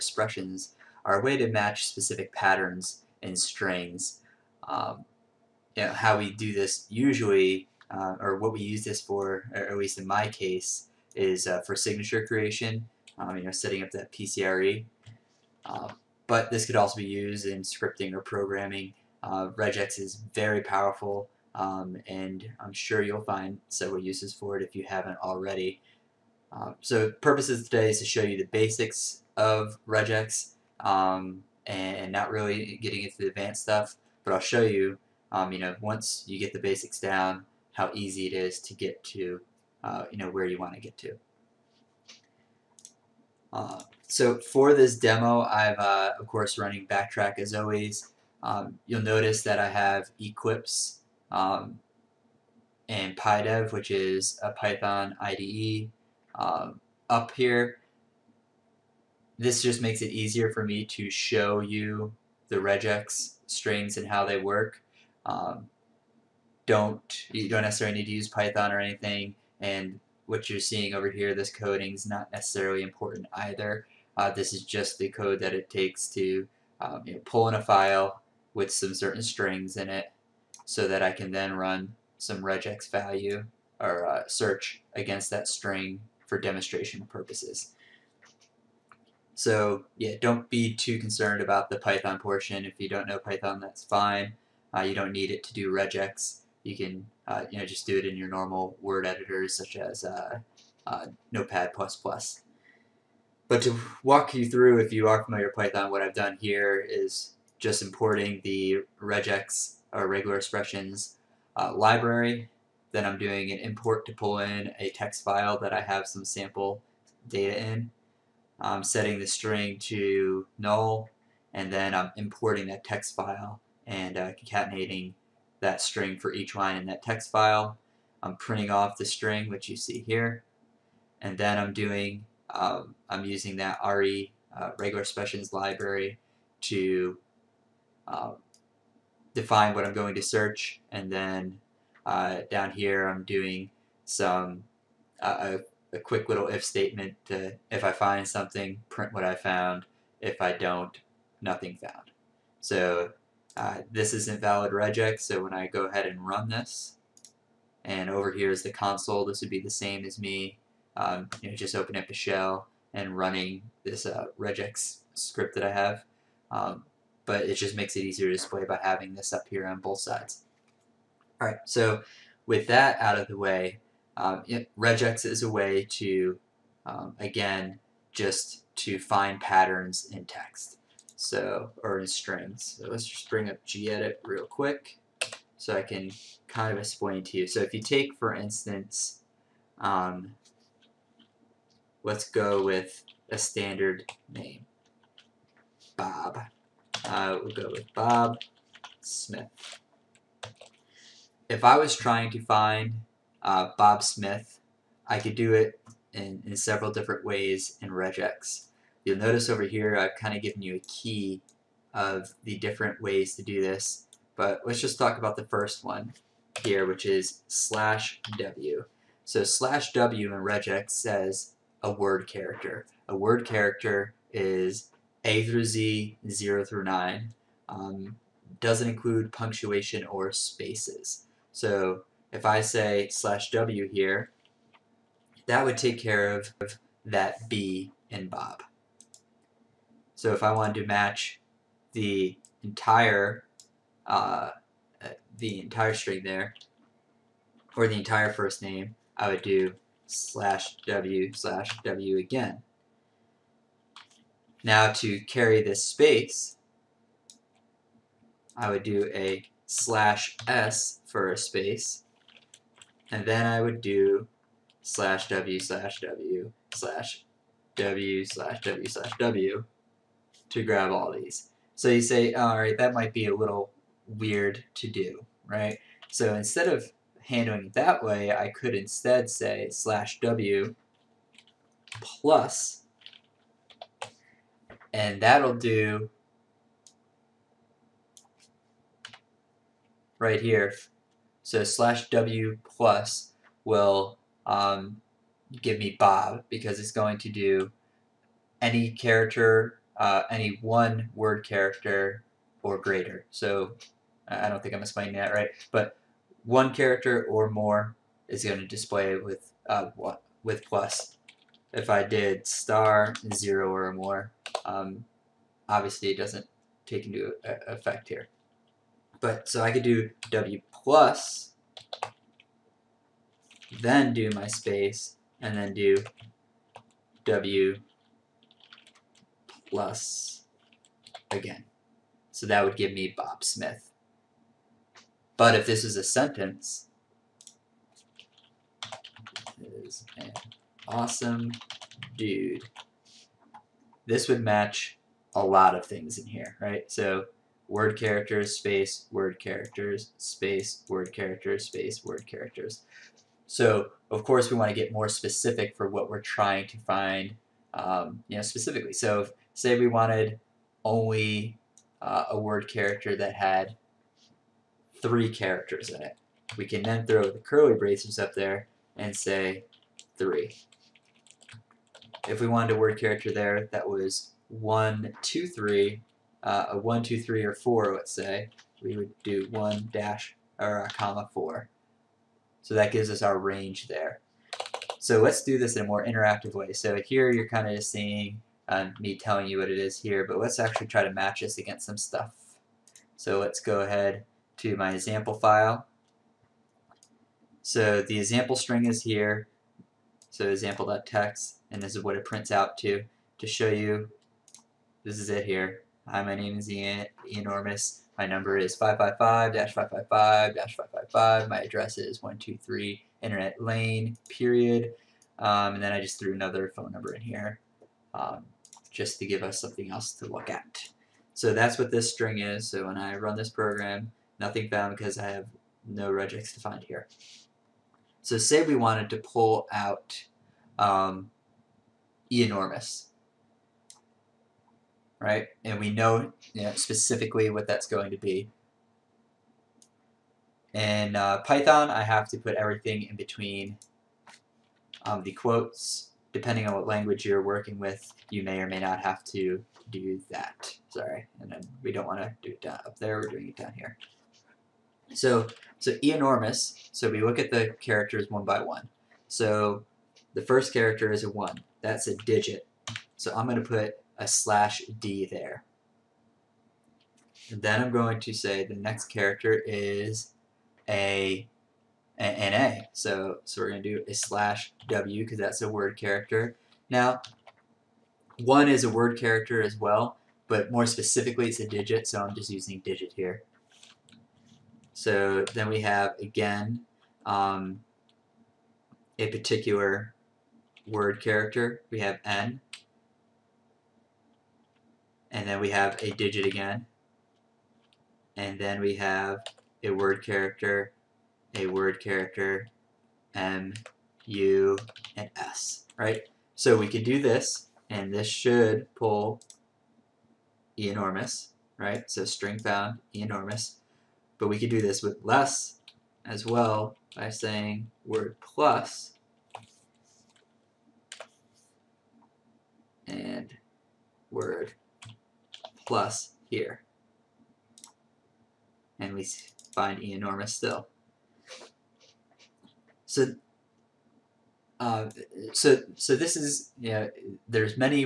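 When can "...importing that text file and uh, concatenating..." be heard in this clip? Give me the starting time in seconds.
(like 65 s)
122 s.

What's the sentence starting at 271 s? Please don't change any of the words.
So you say, oh, all right, that might be a little weird to do, right?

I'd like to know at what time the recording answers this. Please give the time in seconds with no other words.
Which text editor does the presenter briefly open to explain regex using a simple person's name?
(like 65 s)
183 s.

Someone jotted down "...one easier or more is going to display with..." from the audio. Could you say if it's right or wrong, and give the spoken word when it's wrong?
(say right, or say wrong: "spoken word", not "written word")
wrong: "character", not "easier".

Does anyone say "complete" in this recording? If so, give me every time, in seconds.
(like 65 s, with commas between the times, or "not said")
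not said.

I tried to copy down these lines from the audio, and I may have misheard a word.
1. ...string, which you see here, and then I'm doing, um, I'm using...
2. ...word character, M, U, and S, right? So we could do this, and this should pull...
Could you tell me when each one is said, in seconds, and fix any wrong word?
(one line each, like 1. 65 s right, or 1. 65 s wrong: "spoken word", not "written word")
1. 129 s right
2. 501 s right.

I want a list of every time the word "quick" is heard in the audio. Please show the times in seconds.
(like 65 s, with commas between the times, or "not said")
145 s, 184 s.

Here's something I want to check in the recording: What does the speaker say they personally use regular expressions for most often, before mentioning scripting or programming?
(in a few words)
Signature creation.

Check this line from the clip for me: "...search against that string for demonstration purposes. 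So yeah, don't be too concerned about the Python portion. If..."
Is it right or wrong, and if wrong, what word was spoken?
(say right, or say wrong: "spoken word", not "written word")
right.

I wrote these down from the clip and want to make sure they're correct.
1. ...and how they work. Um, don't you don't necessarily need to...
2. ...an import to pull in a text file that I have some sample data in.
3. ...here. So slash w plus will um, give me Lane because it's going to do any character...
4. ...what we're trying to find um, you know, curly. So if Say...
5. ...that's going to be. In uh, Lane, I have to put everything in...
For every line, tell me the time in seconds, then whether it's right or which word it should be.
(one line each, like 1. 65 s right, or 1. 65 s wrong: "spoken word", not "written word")
1. 63 s right
2. 113 s right
3. 290 s wrong: "Bob", not "Lane"
4. 355 s wrong: "specifically", not "curly"
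5. 437 s wrong: "Python", not "Lane".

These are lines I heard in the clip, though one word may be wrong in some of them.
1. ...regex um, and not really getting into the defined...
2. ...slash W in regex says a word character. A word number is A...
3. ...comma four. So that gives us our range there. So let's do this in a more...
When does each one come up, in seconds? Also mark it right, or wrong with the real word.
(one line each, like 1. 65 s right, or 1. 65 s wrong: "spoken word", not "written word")
1. 29 s wrong: "advanced", not "defined"
2. 219 s wrong: "character", not "number"
3. 380 s right.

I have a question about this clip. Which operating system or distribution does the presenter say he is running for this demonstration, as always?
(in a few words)
BackTrack.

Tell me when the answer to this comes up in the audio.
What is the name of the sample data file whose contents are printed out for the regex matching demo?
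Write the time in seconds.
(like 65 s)
400 s.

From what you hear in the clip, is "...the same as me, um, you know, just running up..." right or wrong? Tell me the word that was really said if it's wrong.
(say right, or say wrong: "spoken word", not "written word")
wrong: "opening", not "running".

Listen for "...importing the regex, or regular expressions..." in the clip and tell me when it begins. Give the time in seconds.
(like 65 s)
107 s.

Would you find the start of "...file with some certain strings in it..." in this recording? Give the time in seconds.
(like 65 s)
77 s.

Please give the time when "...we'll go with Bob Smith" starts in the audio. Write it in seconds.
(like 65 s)
197 s.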